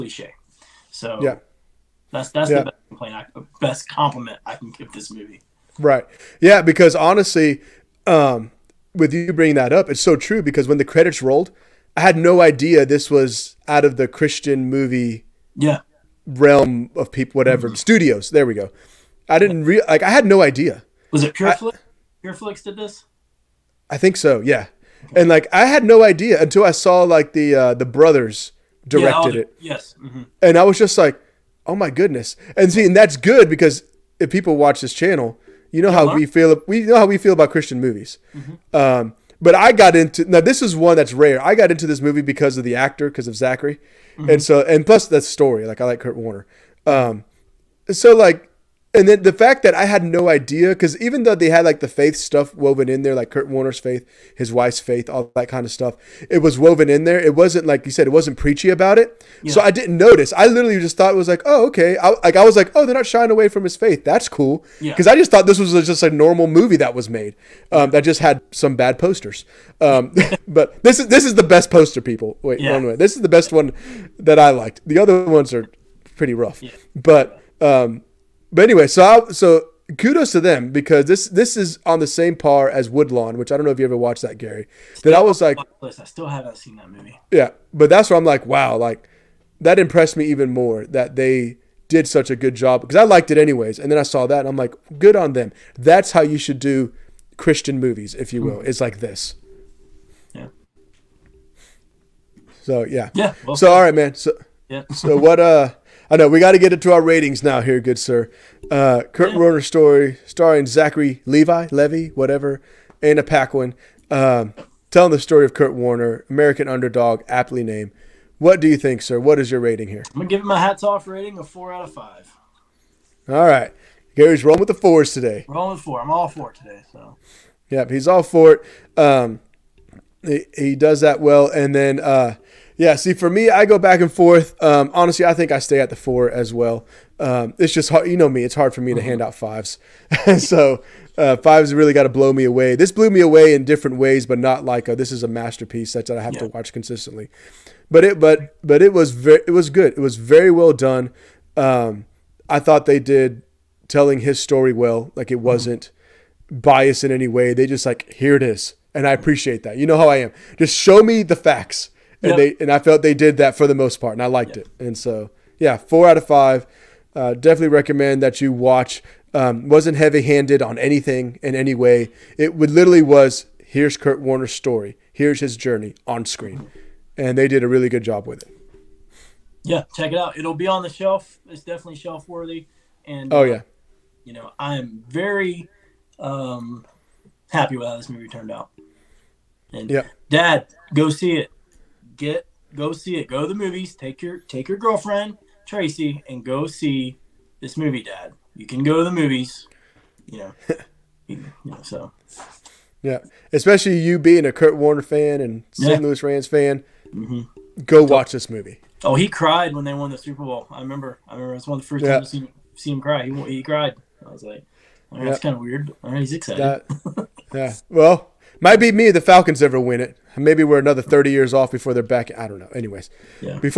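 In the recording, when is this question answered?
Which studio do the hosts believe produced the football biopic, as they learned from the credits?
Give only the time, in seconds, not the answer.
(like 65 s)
21 s.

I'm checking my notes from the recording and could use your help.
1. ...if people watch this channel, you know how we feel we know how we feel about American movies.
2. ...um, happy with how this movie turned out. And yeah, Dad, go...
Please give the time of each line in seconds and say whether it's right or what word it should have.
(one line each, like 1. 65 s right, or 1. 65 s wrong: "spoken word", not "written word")
1. 34 s wrong: "Christian", not "American"
2. 186 s right.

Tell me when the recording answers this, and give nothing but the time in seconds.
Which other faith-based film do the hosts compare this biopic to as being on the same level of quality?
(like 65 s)
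82 s.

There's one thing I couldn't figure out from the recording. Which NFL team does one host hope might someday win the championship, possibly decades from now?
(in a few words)
Falcons.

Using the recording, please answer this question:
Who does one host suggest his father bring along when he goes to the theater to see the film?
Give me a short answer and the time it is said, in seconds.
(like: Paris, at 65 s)
Tracy, at 195 s.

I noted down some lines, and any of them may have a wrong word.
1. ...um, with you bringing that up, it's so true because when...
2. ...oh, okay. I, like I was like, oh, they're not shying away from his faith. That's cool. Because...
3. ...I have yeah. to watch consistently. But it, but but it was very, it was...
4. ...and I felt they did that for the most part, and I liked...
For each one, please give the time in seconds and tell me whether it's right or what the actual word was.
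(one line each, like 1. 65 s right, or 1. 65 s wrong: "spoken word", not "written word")
1. 8 s right
2. 61 s right
3. 146 s right
4. 162 s right.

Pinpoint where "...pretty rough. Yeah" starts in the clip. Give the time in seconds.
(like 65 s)
76 s.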